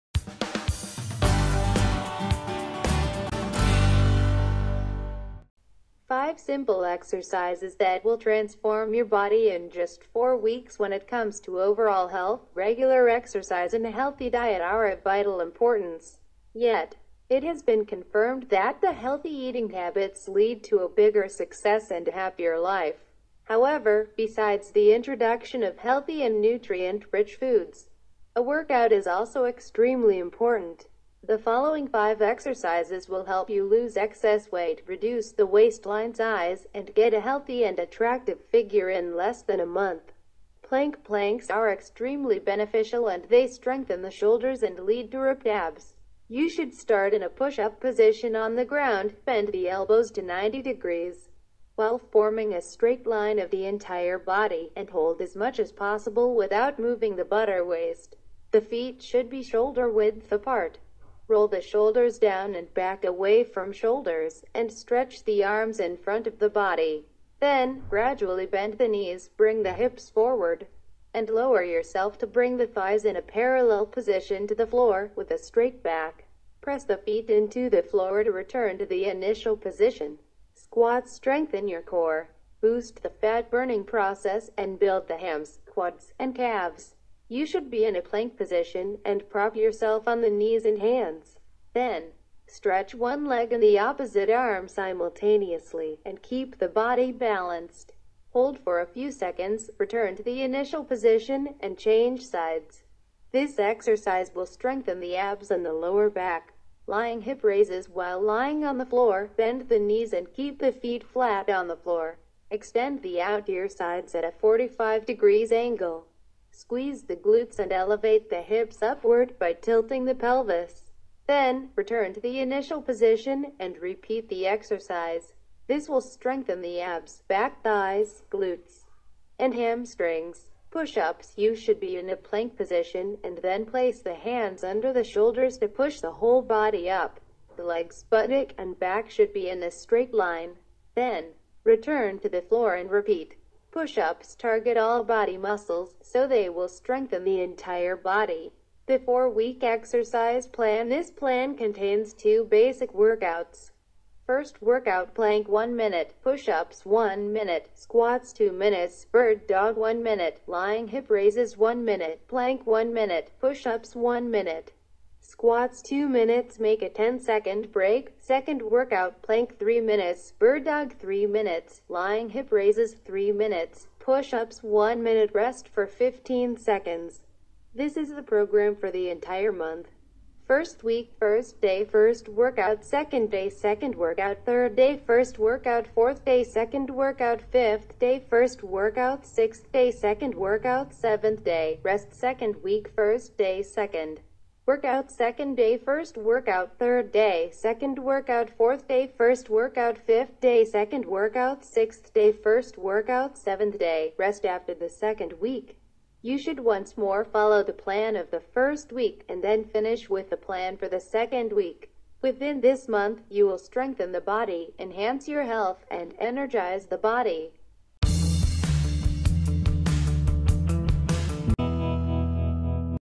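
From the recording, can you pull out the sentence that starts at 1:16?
Press the feet into the floor to return to the initial position.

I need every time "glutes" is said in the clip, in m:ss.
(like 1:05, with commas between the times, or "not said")
1:57, 2:08.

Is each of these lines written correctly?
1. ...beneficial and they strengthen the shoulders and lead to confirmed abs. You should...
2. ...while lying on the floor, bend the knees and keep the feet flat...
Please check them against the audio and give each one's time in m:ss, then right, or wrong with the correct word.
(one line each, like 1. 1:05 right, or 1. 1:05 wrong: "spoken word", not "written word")
1. 0:42 wrong: "ripped", not "confirmed"
2. 1:47 right.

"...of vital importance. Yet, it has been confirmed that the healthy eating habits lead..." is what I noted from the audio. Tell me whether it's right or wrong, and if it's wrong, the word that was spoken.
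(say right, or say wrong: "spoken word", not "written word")
right.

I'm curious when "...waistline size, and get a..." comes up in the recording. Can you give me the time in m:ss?
0:35.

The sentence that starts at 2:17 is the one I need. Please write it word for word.
The legs, buttock, and back should be in a straight line.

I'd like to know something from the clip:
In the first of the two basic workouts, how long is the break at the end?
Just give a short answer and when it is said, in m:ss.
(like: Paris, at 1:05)
10 seconds, at 2:46.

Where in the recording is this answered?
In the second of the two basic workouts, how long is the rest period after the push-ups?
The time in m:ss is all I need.
2:55.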